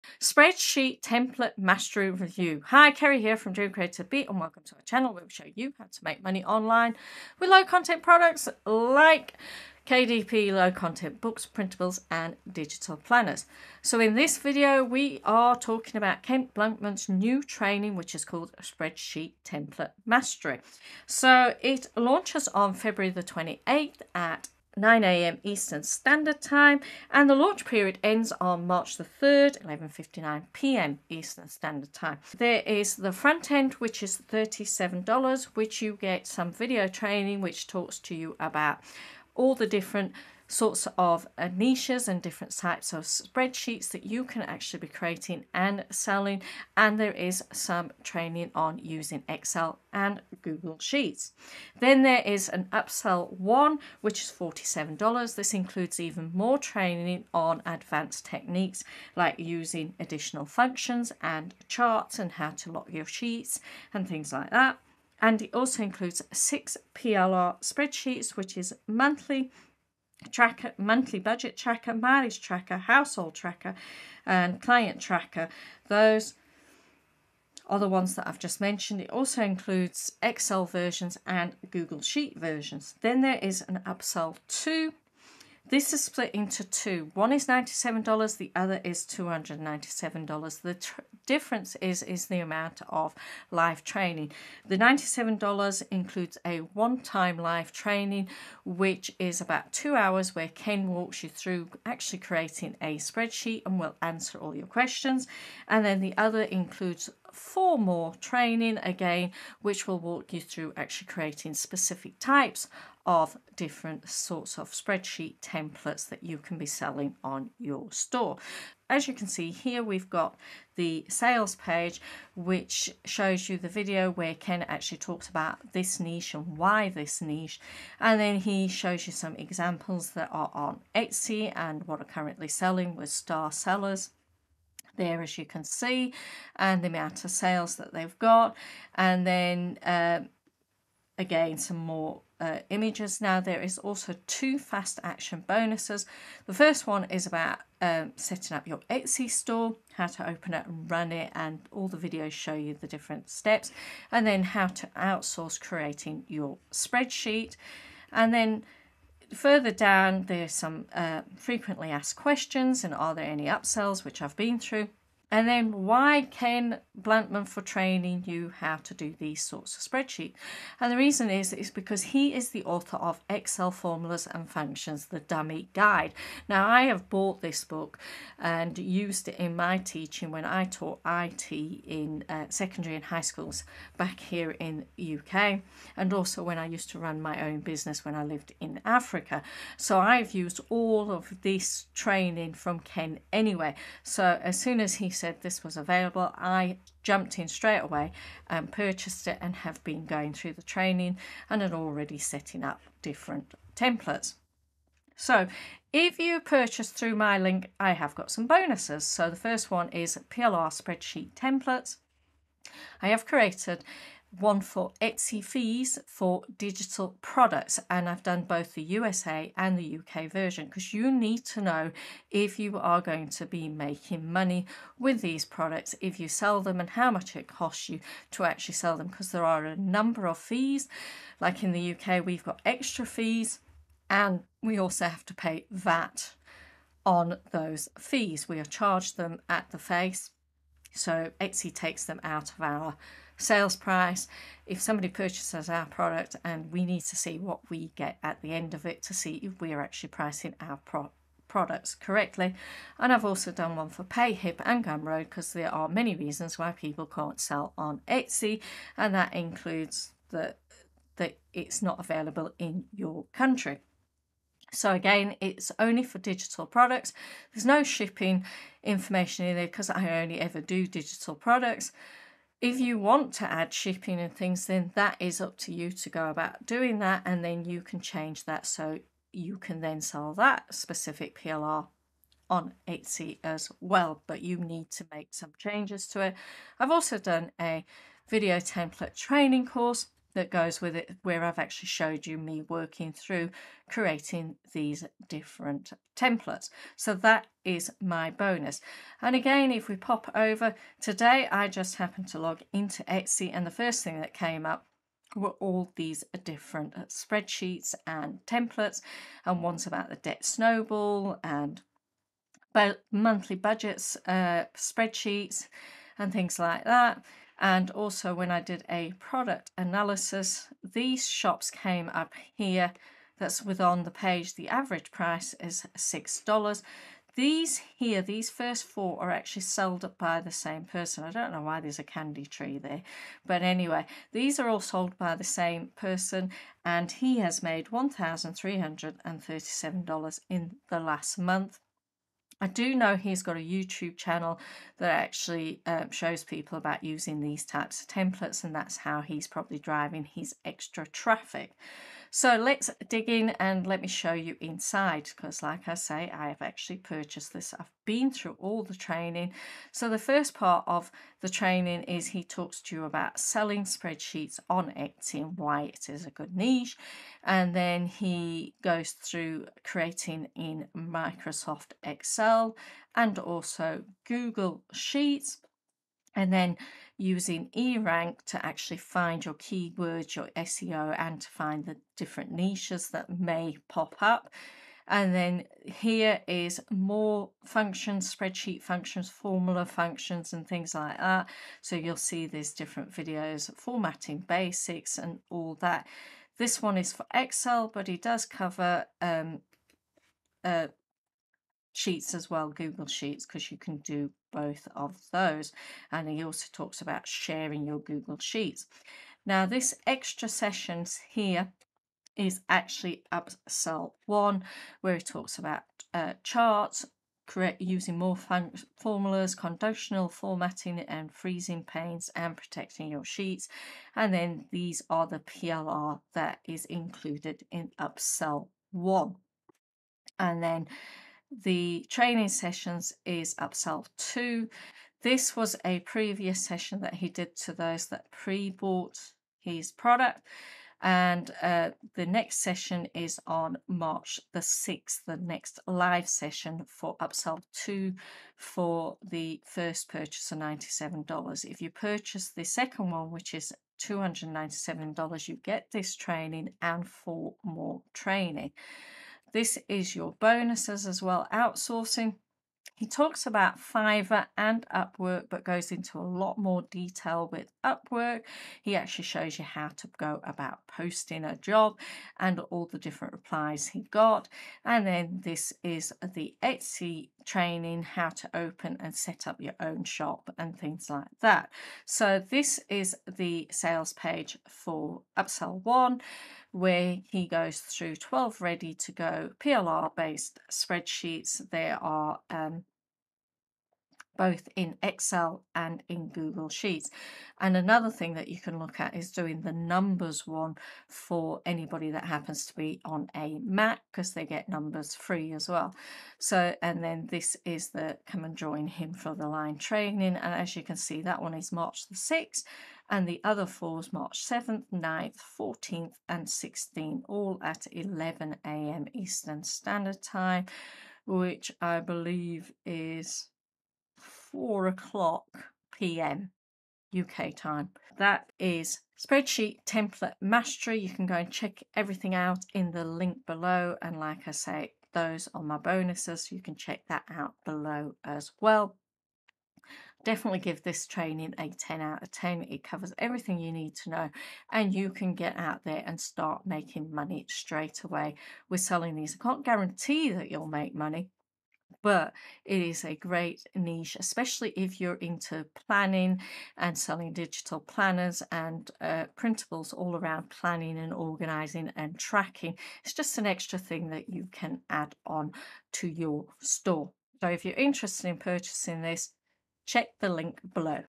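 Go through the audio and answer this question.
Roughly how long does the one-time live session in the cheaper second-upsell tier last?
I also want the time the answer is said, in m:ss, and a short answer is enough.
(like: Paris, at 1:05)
2 hours, at 1:39.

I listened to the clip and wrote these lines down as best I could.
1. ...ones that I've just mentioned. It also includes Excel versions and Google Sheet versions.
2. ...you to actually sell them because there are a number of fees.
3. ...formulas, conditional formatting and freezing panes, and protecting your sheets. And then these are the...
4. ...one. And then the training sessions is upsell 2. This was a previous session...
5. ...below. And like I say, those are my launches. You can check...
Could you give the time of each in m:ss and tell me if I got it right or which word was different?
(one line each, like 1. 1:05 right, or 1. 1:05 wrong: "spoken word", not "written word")
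1. 1:17 right
2. 3:47 right
3. 6:58 right
4. 7:08 right
5. 8:53 wrong: "bonuses", not "launches".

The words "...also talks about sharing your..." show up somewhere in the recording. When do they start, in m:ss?
6:46.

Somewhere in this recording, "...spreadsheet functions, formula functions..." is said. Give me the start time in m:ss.
6:28.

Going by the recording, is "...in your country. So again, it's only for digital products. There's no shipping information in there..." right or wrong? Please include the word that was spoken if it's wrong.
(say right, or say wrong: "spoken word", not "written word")
right.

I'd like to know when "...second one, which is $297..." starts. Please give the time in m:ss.
7:32.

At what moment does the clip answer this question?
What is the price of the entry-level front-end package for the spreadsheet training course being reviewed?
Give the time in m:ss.
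0:34.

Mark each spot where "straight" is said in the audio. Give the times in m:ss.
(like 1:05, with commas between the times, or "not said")
3:17, 9:07.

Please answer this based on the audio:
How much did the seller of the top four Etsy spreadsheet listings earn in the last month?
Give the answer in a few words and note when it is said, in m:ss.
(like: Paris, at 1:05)
$1,337, at 5:37.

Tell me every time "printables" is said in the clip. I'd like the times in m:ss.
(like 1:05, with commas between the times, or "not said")
0:11, 9:19.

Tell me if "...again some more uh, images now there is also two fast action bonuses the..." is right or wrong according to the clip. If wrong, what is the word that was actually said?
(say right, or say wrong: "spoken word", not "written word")
right.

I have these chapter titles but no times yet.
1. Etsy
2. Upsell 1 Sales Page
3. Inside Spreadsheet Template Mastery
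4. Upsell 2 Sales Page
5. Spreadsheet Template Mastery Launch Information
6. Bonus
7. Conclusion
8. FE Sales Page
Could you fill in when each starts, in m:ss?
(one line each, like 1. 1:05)
1. 5:03
2. 8:07
3. 5:58
4. 8:26
5. 0:23
6. 3:30
7. 8:54
8. 2:01.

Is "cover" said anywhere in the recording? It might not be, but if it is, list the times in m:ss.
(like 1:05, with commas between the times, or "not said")
6:38, 9:02.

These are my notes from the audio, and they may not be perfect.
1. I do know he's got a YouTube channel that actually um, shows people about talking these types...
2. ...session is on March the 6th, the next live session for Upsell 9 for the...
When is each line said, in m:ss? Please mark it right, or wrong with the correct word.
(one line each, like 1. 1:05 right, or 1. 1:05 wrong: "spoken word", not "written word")
1. 5:42 wrong: "using", not "talking"
2. 7:22 wrong: "2", not "9".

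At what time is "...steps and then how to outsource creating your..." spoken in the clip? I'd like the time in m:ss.
2:33.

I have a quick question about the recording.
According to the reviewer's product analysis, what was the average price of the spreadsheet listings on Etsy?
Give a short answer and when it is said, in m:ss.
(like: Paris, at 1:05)
$6, at 5:25.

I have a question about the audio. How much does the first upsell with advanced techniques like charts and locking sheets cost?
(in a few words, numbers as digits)
$47.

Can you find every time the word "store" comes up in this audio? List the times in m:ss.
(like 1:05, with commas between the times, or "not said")
1:57, 2:29, 9:26.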